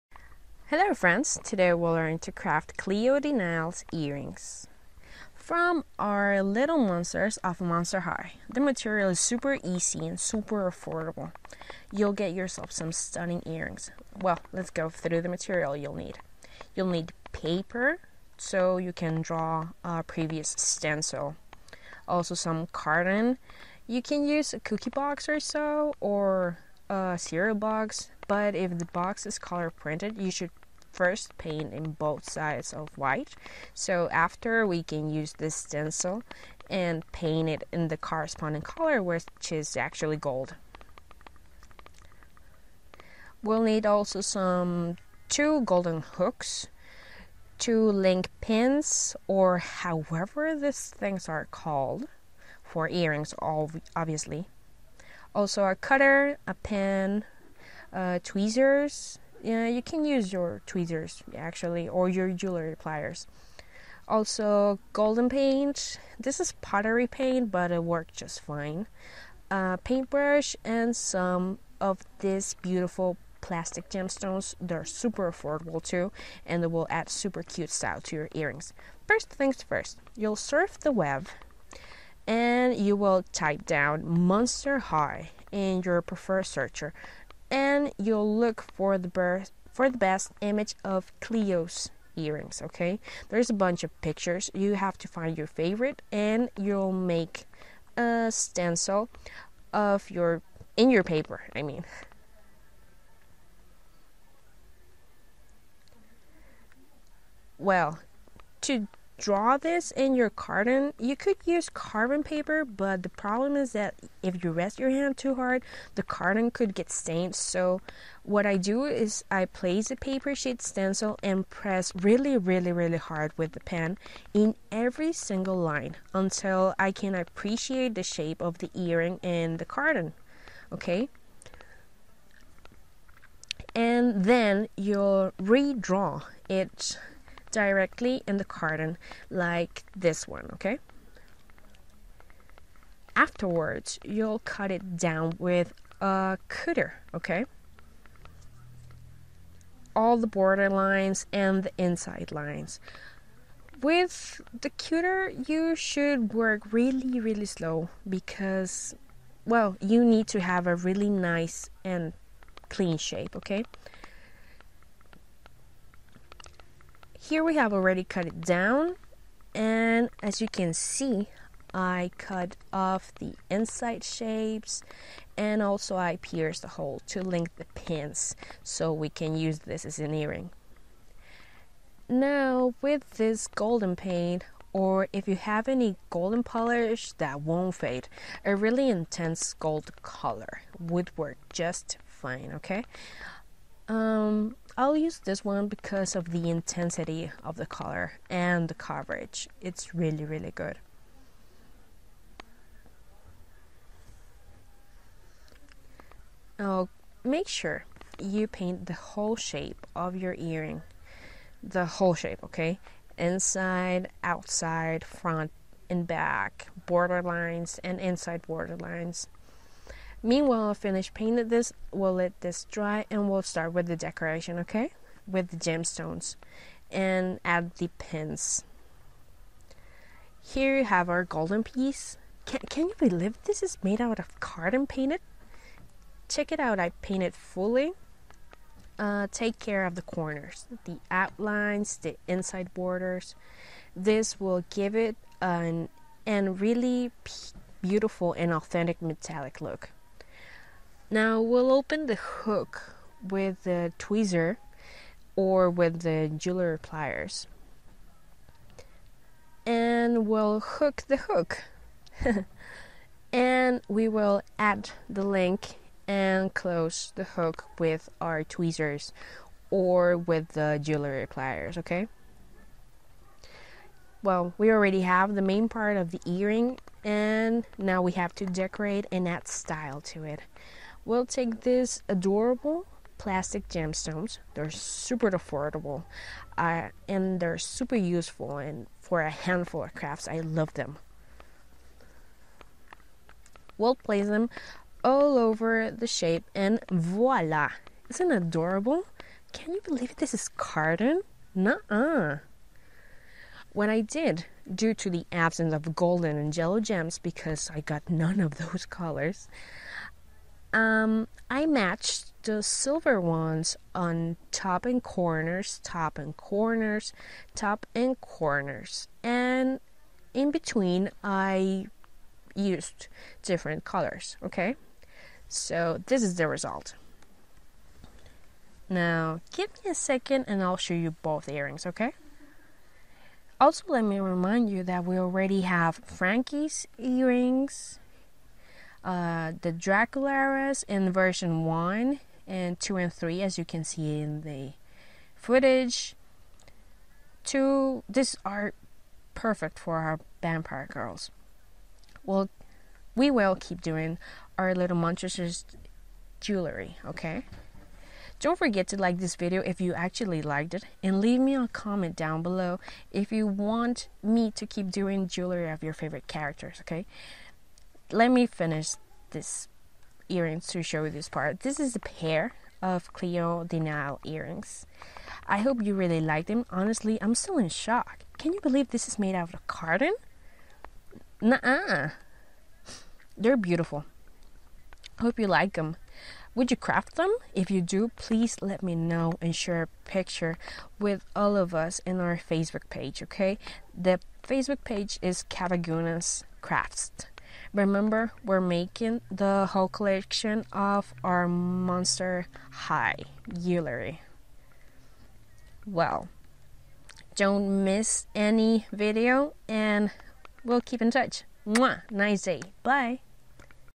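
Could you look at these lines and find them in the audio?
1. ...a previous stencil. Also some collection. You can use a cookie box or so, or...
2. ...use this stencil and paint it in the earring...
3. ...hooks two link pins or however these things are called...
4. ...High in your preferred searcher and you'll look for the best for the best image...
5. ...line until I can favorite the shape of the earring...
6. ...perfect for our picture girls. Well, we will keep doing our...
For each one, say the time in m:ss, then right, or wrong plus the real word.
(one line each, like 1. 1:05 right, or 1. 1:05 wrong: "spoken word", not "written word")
1. 0:19 wrong: "carton", not "collection"
2. 0:35 wrong: "corresponding", not "earring"
3. 0:46 right
4. 1:24 right
5. 2:05 wrong: "appreciate", not "favorite"
6. 5:49 wrong: "vampire", not "picture".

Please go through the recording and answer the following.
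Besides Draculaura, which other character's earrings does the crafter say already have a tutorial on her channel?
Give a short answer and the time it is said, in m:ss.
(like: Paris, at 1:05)
Frankie, at 5:35.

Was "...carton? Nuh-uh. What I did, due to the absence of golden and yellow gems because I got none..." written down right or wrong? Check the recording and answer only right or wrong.
right.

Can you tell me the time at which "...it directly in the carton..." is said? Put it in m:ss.
2:16.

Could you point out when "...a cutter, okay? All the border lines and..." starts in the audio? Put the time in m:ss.
2:25.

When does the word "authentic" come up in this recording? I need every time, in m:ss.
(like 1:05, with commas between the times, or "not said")
4:08.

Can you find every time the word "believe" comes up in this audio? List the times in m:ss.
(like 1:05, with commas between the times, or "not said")
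3:52, 4:59, 6:18.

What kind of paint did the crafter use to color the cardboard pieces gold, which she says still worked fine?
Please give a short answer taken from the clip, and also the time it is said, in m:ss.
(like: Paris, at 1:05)
Pottery paint, at 1:06.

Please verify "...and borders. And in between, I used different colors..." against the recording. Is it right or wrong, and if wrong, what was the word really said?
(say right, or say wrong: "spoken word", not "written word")
wrong: "corners", not "borders".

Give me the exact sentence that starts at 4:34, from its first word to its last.
Well, we already have the main part of the earring and now we have to decorate and add style to it.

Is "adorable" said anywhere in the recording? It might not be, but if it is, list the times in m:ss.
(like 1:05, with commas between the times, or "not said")
4:42, 4:58.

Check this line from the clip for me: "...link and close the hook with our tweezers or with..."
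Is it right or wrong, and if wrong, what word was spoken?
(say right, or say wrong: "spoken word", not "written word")
right.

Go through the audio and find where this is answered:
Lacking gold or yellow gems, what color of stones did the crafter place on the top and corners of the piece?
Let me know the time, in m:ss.
5:12.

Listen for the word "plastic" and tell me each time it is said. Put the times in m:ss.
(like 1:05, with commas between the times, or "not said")
1:13, 4:43.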